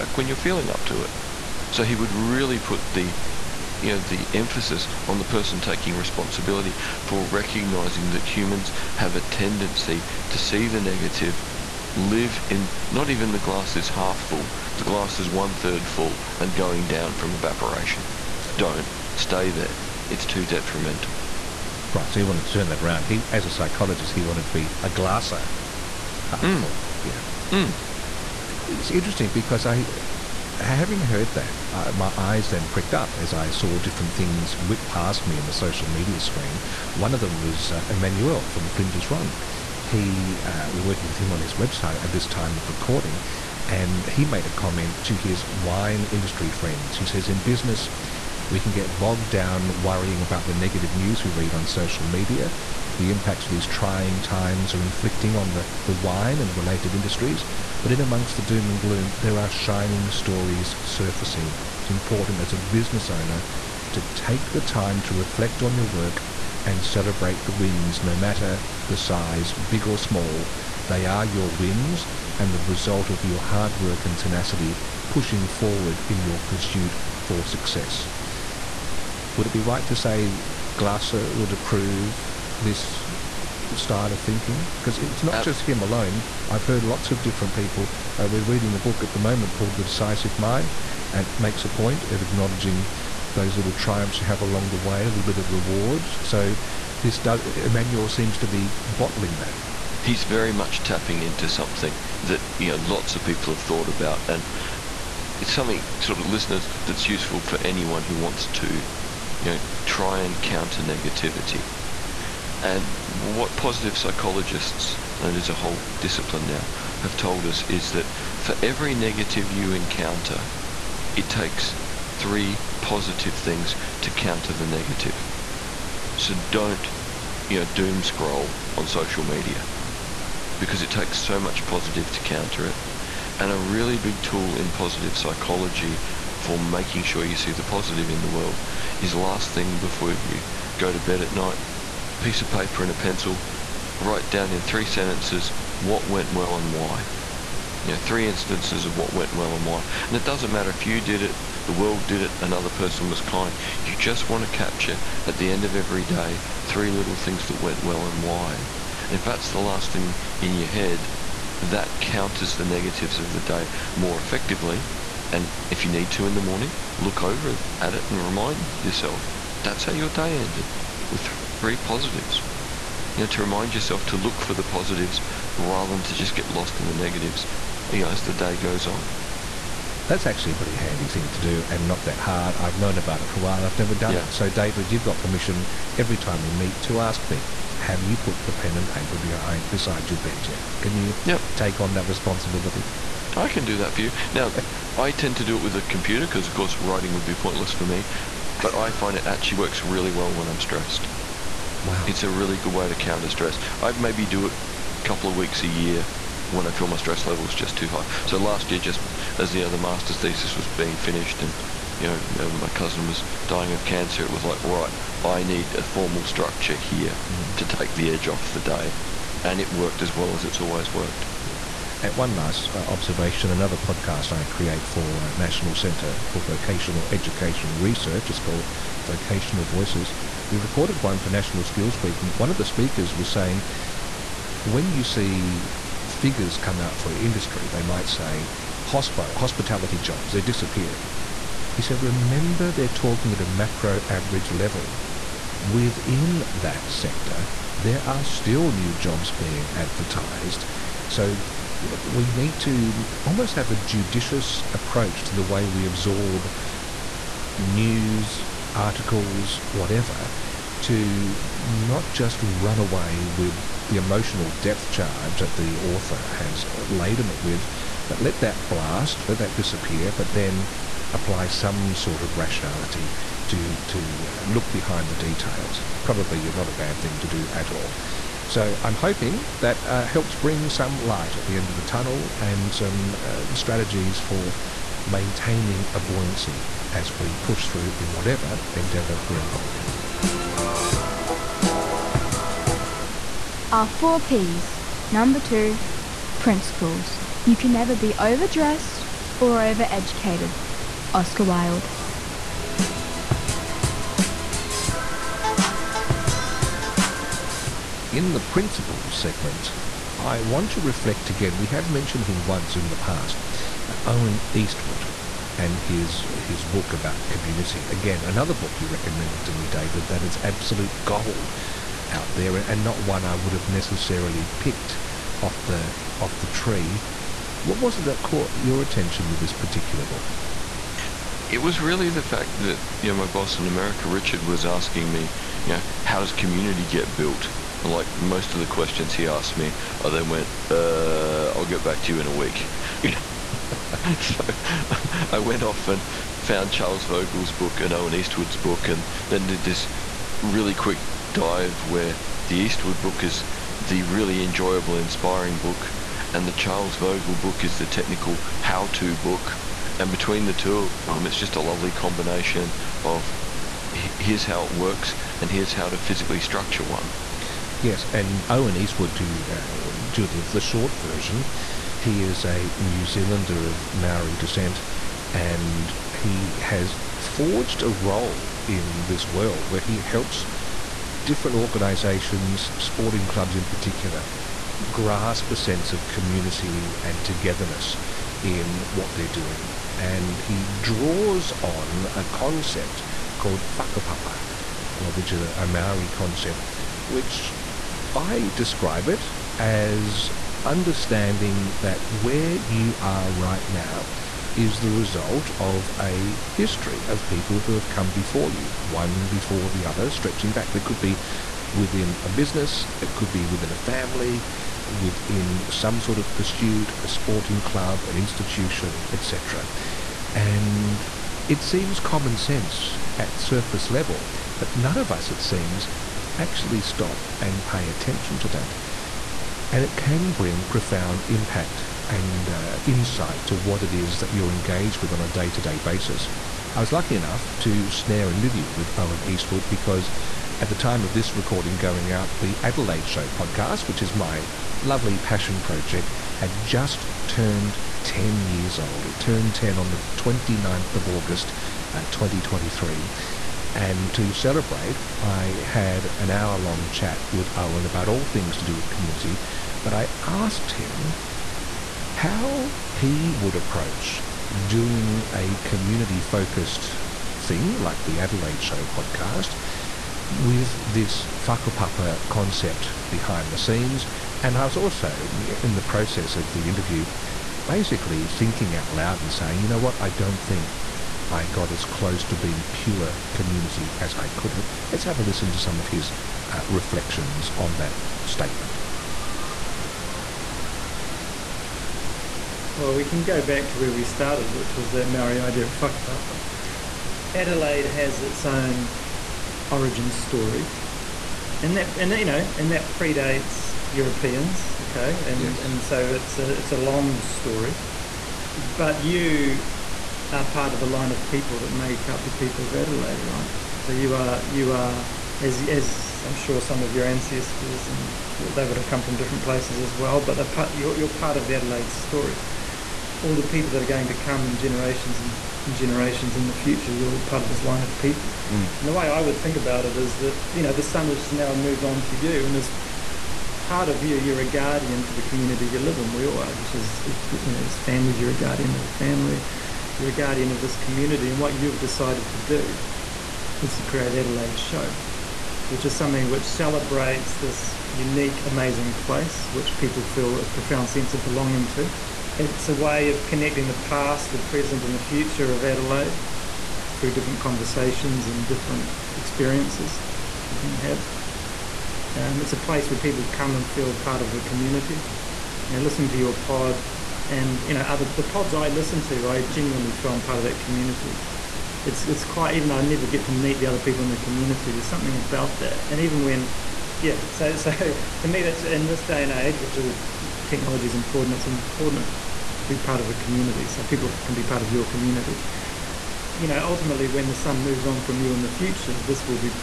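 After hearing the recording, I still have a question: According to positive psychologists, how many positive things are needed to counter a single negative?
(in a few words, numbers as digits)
3.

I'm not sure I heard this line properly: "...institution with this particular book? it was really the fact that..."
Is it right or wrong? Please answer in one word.
wrong.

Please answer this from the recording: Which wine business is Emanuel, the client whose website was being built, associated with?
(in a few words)
Flinders Run.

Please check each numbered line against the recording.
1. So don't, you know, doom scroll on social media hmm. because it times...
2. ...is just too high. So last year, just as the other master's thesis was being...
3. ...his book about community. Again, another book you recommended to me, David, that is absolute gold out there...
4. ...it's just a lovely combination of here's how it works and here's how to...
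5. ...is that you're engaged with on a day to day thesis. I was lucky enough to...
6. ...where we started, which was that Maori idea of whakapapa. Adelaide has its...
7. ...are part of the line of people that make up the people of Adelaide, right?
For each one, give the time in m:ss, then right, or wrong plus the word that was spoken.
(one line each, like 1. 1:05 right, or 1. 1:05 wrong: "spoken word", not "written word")
1. 2:06 wrong: "takes", not "times"
2. 3:27 right
3. 5:16 right
4. 6:01 right
5. 7:13 wrong: "basis", not "thesis"
6. 8:13 right
7. 8:30 right.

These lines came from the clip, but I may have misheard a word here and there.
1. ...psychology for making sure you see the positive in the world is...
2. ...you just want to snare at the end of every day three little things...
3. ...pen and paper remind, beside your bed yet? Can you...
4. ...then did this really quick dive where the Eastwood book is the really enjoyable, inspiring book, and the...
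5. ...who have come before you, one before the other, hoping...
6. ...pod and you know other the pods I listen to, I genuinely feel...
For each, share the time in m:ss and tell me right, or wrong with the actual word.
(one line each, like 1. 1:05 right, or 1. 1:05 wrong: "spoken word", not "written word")
1. 2:15 right
2. 2:33 wrong: "capture", not "snare"
3. 3:08 wrong: "behind", not "remind"
4. 5:49 right
5. 6:47 wrong: "stretching", not "hoping"
6. 9:26 right.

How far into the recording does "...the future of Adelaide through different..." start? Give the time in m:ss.
9:14.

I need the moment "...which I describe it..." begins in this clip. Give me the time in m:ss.
6:37.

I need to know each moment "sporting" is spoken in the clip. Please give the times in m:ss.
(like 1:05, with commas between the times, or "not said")
6:22, 6:57.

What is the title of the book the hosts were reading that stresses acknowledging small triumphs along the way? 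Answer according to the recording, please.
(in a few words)
The Decisive Mind.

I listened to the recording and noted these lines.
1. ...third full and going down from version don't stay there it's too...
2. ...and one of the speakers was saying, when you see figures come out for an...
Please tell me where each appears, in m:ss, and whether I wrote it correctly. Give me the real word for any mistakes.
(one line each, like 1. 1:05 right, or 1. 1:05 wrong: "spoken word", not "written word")
1. 0:15 wrong: "evaporation", not "version"
2. 3:52 right.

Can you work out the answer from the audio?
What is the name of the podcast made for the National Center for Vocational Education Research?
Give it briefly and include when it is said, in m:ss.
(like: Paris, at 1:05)
Vocational Voices, at 3:49.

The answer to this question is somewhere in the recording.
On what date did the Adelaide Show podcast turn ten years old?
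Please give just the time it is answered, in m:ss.
7:30.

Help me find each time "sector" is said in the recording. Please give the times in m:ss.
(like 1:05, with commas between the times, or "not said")
4:06.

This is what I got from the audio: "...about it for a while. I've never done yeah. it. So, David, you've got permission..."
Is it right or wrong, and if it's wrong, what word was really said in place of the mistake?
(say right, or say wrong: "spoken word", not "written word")
right.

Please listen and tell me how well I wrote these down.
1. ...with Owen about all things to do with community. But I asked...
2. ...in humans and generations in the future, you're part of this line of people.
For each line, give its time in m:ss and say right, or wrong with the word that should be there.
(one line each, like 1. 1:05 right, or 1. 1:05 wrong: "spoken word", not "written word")
1. 7:37 right
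2. 8:44 wrong: "generations", not "humans".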